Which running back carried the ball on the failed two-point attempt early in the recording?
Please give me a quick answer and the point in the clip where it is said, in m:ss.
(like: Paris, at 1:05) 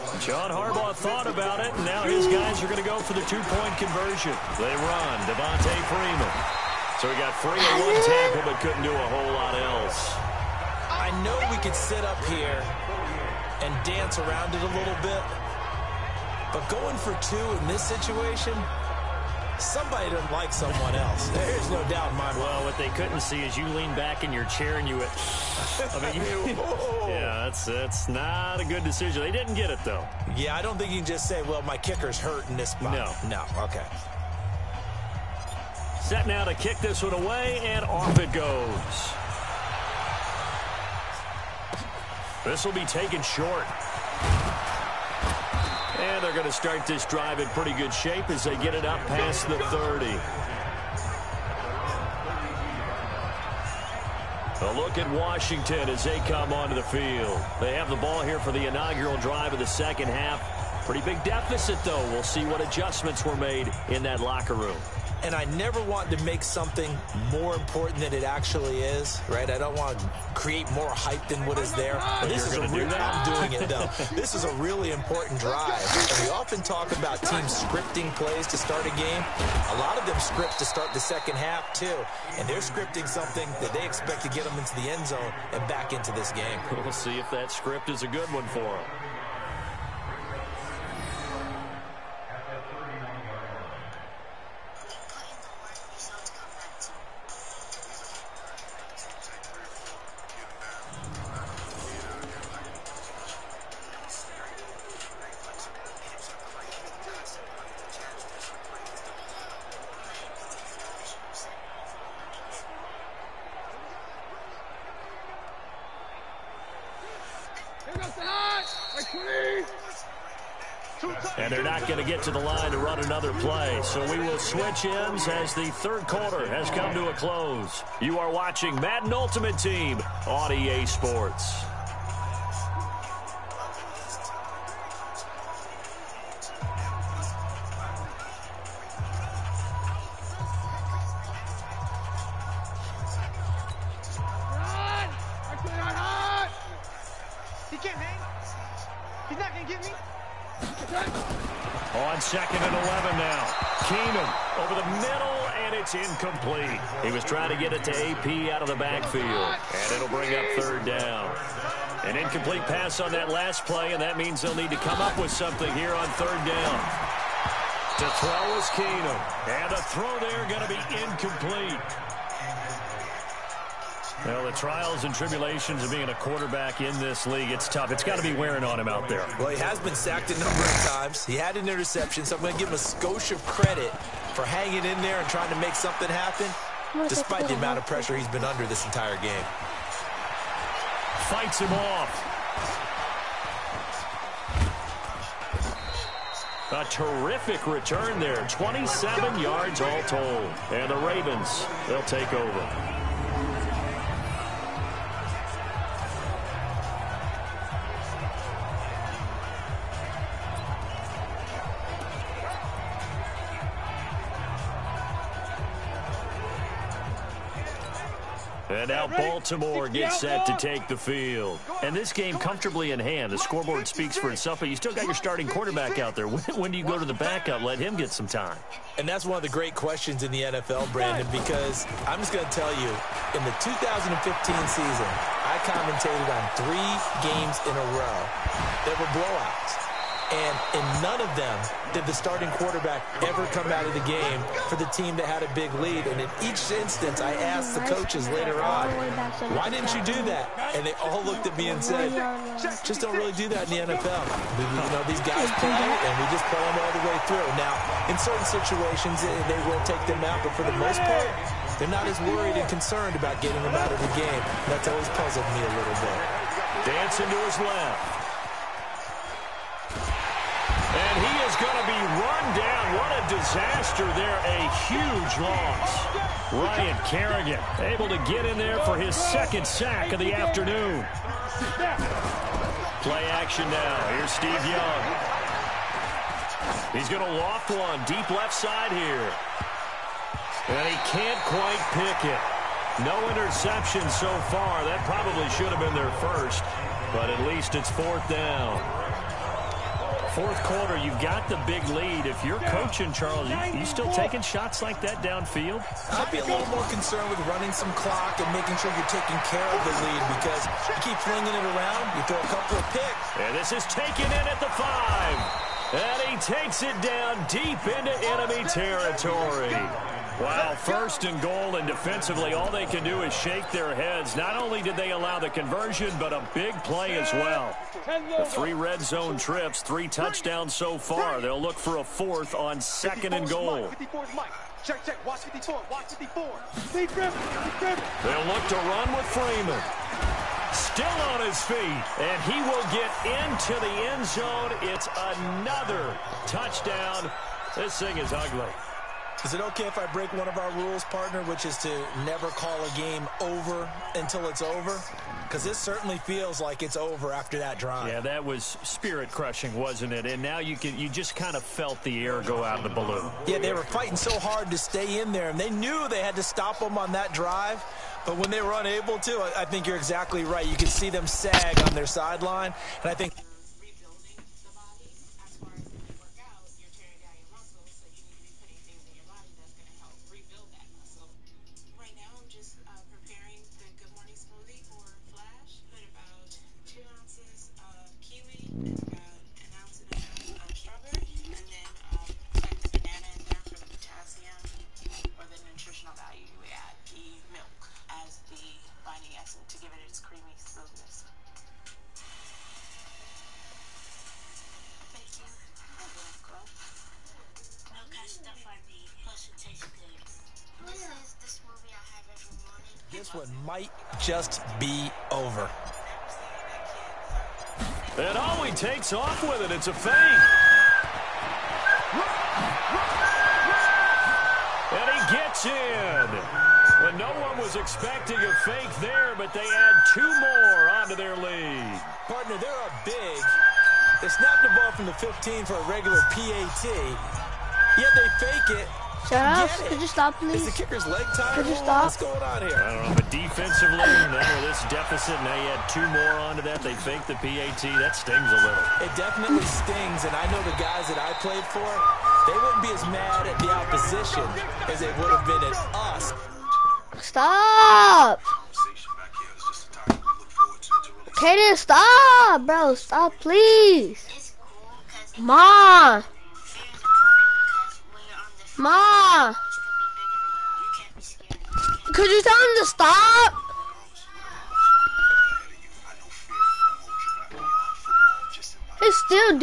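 Devonta Freeman, at 0:05.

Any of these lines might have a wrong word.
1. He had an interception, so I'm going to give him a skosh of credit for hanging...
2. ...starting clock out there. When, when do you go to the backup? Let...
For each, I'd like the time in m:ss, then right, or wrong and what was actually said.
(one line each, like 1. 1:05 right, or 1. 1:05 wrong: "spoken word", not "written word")
1. 3:01 right
2. 3:45 wrong: "quarterback", not "clock".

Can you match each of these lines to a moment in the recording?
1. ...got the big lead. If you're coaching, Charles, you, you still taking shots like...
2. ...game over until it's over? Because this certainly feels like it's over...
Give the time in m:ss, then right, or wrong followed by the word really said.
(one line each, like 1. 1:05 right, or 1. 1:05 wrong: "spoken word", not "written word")
1. 5:01 right
2. 5:52 right.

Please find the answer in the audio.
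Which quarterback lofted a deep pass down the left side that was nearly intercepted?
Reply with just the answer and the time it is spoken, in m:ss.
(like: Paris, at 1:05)
Steve Young, at 4:44.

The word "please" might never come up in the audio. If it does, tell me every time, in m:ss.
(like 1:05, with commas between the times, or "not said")
7:20, 7:43.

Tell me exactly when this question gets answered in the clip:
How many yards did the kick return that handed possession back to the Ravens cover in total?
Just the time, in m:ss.
3:18.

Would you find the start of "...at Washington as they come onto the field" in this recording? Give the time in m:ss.
0:54.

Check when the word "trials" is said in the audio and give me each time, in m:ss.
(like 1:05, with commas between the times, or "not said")
2:54.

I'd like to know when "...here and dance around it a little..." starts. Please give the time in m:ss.
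0:12.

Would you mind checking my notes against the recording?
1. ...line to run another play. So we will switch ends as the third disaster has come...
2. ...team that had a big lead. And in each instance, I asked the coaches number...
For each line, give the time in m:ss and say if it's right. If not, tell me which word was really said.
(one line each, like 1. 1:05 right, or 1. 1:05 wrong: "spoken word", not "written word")
1. 2:02 wrong: "quarter", not "disaster"
2. 4:04 wrong: "later", not "number".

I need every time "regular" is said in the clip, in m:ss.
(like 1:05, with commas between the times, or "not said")
7:15.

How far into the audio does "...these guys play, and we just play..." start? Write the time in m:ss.
4:15.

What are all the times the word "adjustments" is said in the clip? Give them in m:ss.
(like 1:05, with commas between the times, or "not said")
1:02.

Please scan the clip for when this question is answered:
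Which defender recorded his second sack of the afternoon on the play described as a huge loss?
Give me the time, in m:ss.
4:36.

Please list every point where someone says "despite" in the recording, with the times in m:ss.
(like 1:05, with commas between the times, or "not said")
3:07.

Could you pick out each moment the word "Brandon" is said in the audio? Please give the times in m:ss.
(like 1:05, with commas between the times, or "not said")
3:50.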